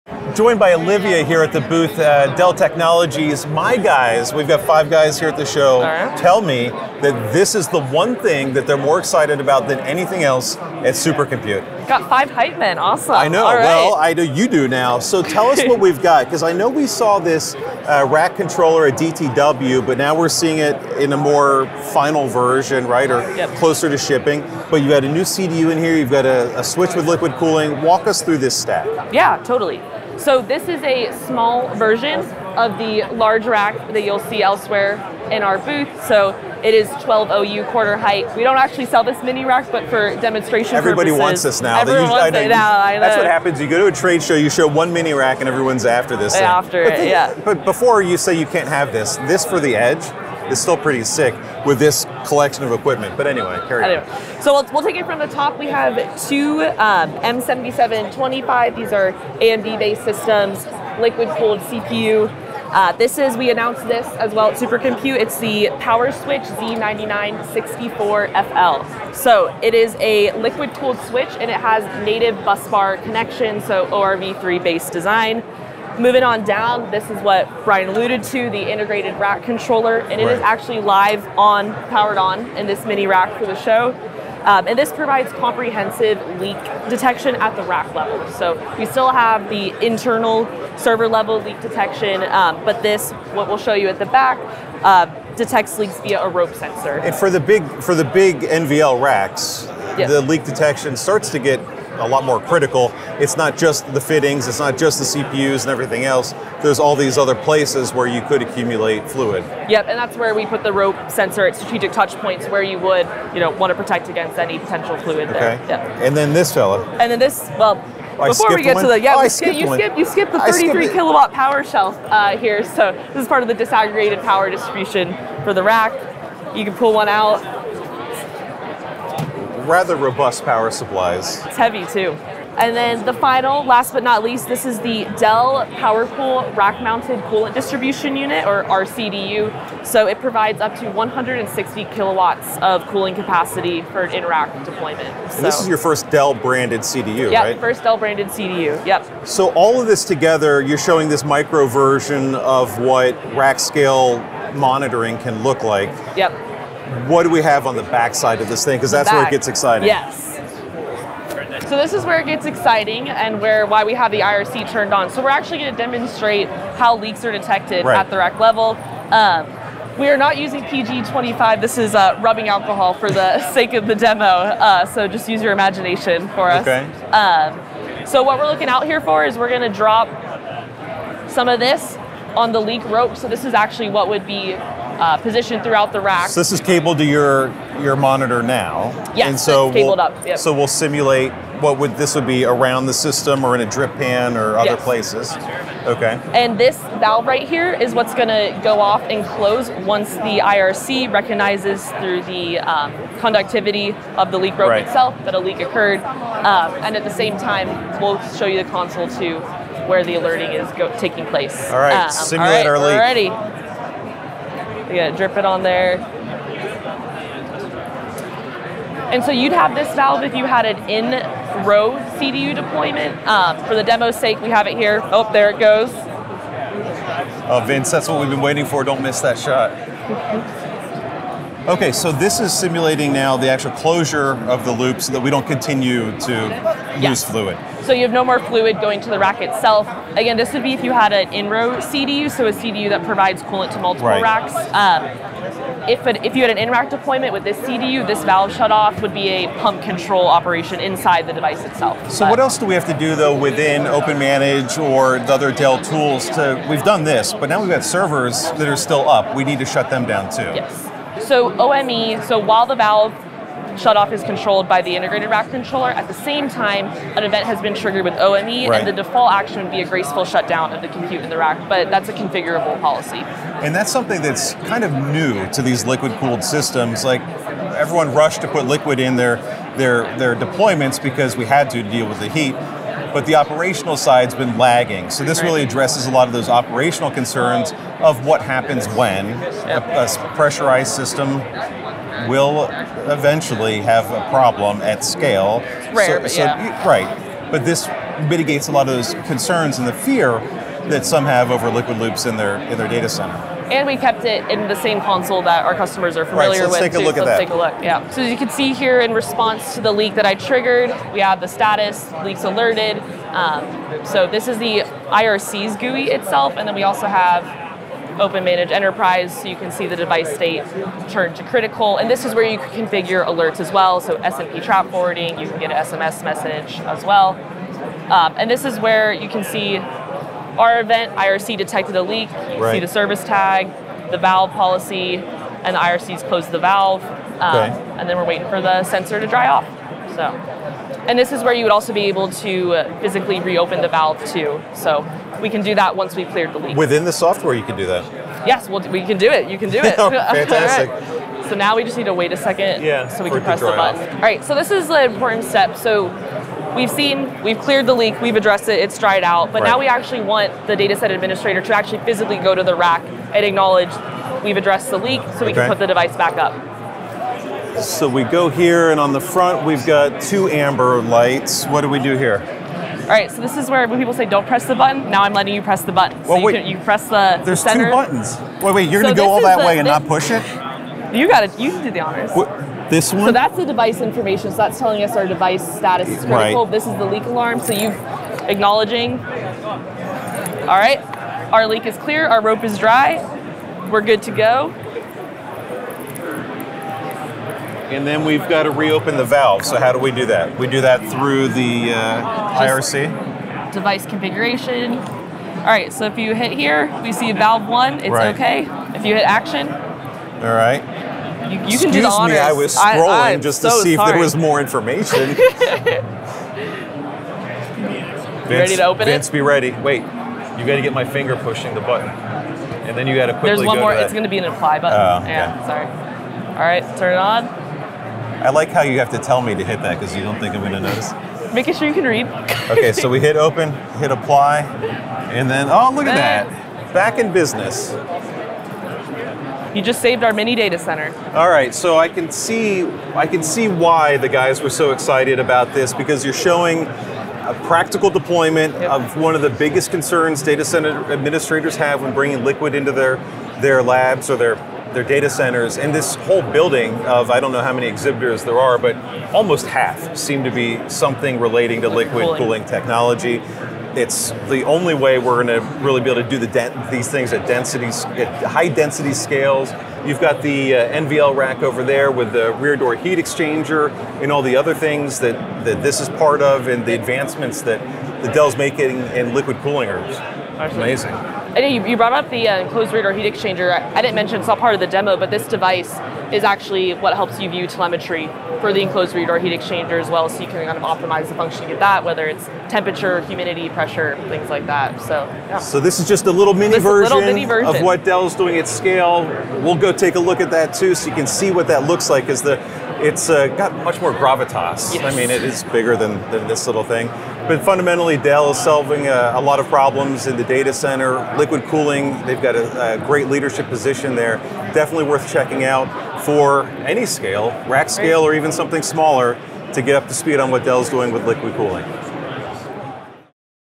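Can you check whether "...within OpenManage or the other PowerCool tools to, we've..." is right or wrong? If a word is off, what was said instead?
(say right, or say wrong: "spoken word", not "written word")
wrong: "Dell", not "PowerCool".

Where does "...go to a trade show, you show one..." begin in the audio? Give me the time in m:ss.
0:43.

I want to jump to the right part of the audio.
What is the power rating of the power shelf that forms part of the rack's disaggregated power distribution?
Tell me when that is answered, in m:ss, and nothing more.
2:00.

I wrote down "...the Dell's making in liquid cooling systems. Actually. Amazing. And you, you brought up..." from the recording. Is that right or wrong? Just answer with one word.
wrong.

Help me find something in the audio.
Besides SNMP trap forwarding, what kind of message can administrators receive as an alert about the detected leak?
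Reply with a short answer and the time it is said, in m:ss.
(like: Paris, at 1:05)
SMS message, at 5:25.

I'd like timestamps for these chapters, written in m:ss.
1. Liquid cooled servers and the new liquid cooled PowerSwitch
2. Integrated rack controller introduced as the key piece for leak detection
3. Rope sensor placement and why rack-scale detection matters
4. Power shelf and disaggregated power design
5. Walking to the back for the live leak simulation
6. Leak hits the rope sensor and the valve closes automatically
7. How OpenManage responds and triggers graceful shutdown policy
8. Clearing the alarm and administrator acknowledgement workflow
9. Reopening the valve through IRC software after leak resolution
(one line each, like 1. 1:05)
1. 0:30
2. 1:17
3. 2:00
4. 2:37
5. 3:40
6. 4:03
7. 4:29
8. 5:10
9. 6:30.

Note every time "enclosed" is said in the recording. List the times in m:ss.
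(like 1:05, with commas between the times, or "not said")
8:02, 8:08.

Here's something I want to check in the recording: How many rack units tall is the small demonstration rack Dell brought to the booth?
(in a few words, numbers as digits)
12 OU.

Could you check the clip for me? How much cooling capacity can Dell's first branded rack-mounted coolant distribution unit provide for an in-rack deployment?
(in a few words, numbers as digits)
160 kilowatts.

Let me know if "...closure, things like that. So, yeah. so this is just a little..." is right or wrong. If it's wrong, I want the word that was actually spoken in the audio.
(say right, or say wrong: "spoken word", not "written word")
wrong: "pressure", not "closure".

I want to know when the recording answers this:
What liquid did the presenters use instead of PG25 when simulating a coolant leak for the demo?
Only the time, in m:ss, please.
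2:52.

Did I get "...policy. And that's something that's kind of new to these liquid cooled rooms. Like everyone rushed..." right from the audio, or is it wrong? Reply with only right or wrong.
wrong.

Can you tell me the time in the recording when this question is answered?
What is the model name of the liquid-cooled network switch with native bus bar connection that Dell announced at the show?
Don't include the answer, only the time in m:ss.
1:05.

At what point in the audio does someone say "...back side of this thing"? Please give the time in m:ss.
2:37.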